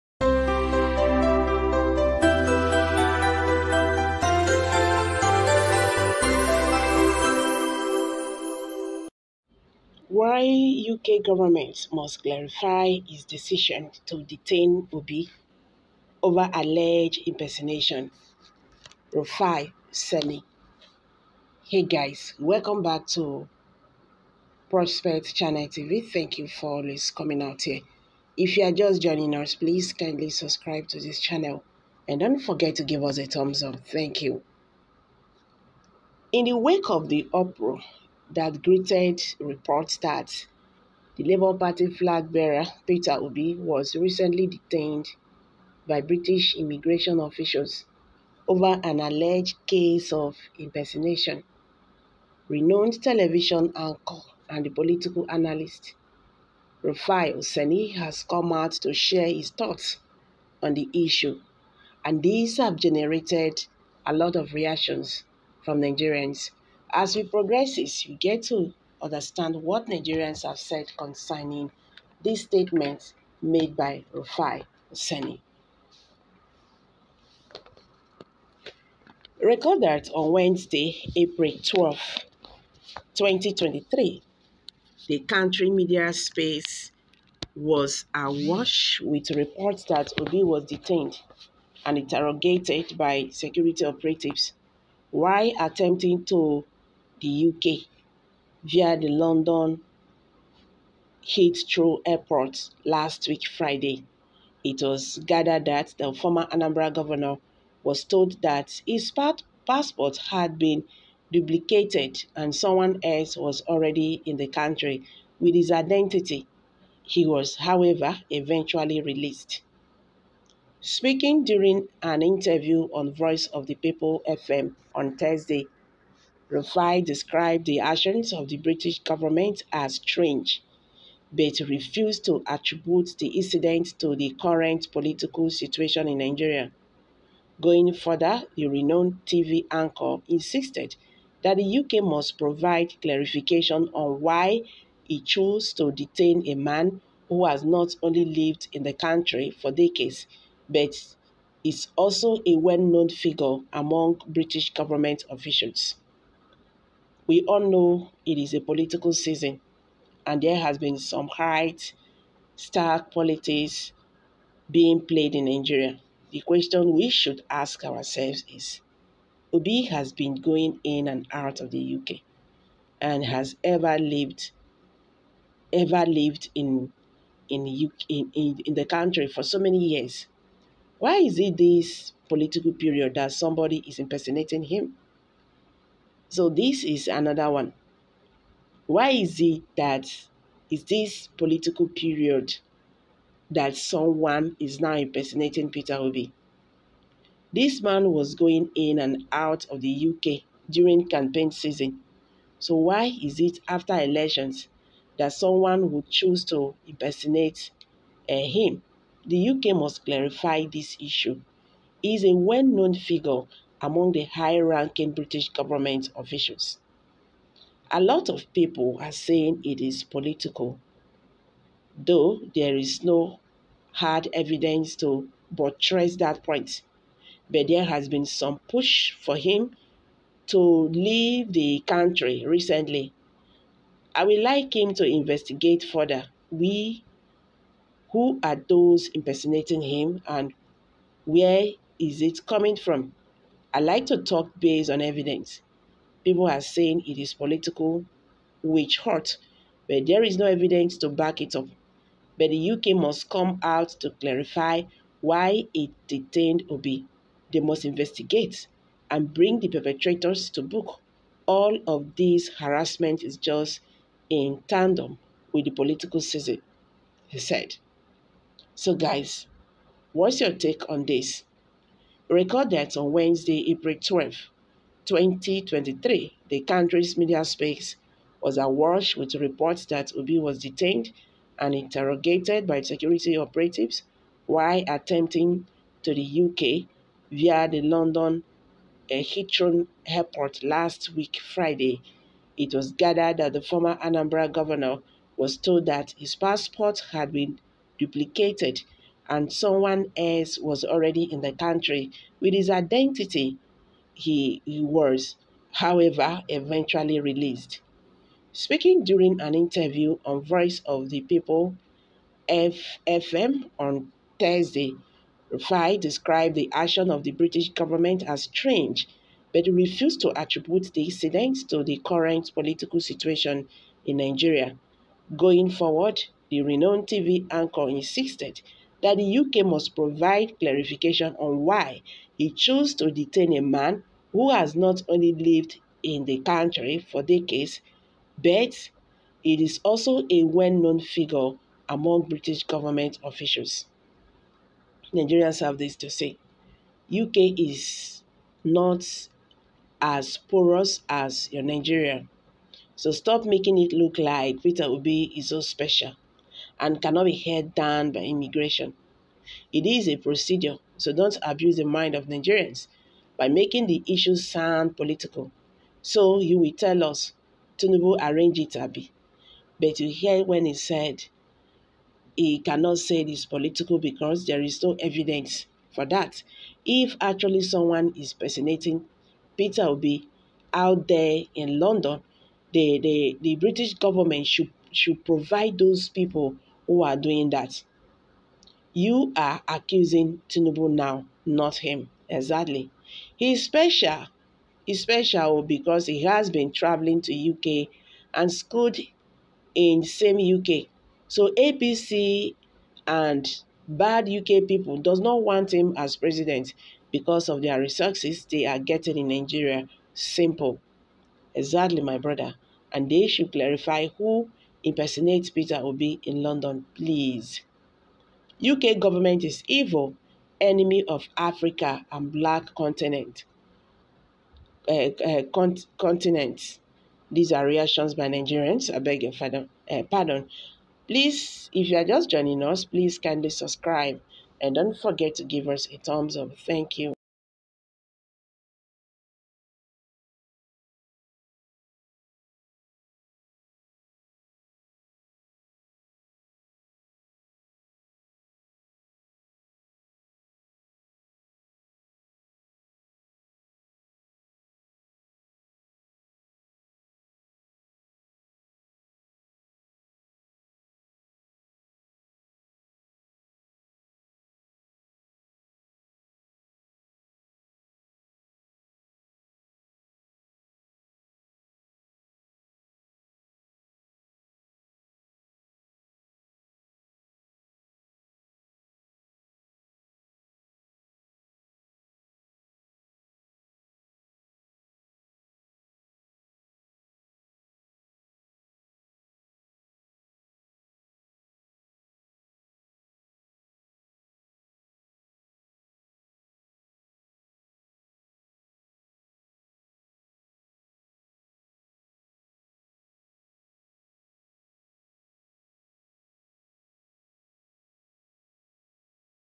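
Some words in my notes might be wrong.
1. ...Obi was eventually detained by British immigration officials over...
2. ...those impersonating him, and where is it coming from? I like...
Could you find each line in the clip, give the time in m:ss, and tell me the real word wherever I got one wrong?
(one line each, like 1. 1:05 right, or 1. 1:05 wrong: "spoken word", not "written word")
1. 0:43 wrong: "recently", not "eventually"
2. 3:58 right.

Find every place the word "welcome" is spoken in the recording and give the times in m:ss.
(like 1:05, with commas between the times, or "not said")
0:22.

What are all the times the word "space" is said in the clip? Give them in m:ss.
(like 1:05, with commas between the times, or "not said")
1:26, 4:37.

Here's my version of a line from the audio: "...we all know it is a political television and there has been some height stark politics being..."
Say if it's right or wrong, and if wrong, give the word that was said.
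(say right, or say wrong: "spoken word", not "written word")
wrong: "season", not "television".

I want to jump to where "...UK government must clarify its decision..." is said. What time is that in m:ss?
0:10.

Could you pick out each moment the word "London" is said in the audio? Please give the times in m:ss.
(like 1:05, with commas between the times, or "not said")
1:39, 4:47, 6:21, 6:56.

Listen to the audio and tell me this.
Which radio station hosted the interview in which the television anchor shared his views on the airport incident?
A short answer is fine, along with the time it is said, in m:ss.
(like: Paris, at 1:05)
Voice of the People FM, at 2:03.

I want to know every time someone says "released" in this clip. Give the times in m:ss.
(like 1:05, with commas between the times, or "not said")
1:59, 5:07.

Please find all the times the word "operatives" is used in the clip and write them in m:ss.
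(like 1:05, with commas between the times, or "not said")
1:33, 4:43.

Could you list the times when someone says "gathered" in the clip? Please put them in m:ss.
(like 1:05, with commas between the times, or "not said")
1:45, 4:52.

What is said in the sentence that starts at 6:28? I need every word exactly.
You are accusing Tinubu now, not him.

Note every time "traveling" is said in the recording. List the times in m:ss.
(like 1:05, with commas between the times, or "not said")
6:36.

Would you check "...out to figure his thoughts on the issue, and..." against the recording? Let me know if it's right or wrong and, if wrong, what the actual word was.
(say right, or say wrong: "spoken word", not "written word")
wrong: "share", not "figure".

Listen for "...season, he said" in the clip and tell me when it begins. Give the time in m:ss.
4:26.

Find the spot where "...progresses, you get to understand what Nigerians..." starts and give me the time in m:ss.
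1:07.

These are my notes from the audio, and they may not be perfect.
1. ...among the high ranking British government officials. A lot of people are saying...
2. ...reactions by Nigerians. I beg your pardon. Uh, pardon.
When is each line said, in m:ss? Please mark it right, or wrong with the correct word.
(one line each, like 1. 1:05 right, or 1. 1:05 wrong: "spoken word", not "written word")
1. 3:33 right
2. 7:07 right.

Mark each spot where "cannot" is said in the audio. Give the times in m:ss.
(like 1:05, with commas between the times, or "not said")
5:57, 6:12.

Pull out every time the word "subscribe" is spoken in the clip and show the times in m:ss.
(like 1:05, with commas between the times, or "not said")
0:30, 7:13.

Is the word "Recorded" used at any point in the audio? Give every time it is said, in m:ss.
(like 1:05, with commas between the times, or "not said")
1:19, 4:32.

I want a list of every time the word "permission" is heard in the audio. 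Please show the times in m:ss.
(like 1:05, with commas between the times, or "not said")
not said.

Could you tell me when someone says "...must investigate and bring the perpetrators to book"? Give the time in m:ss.
4:17.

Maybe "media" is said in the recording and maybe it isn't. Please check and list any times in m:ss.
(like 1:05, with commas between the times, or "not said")
1:25, 4:37.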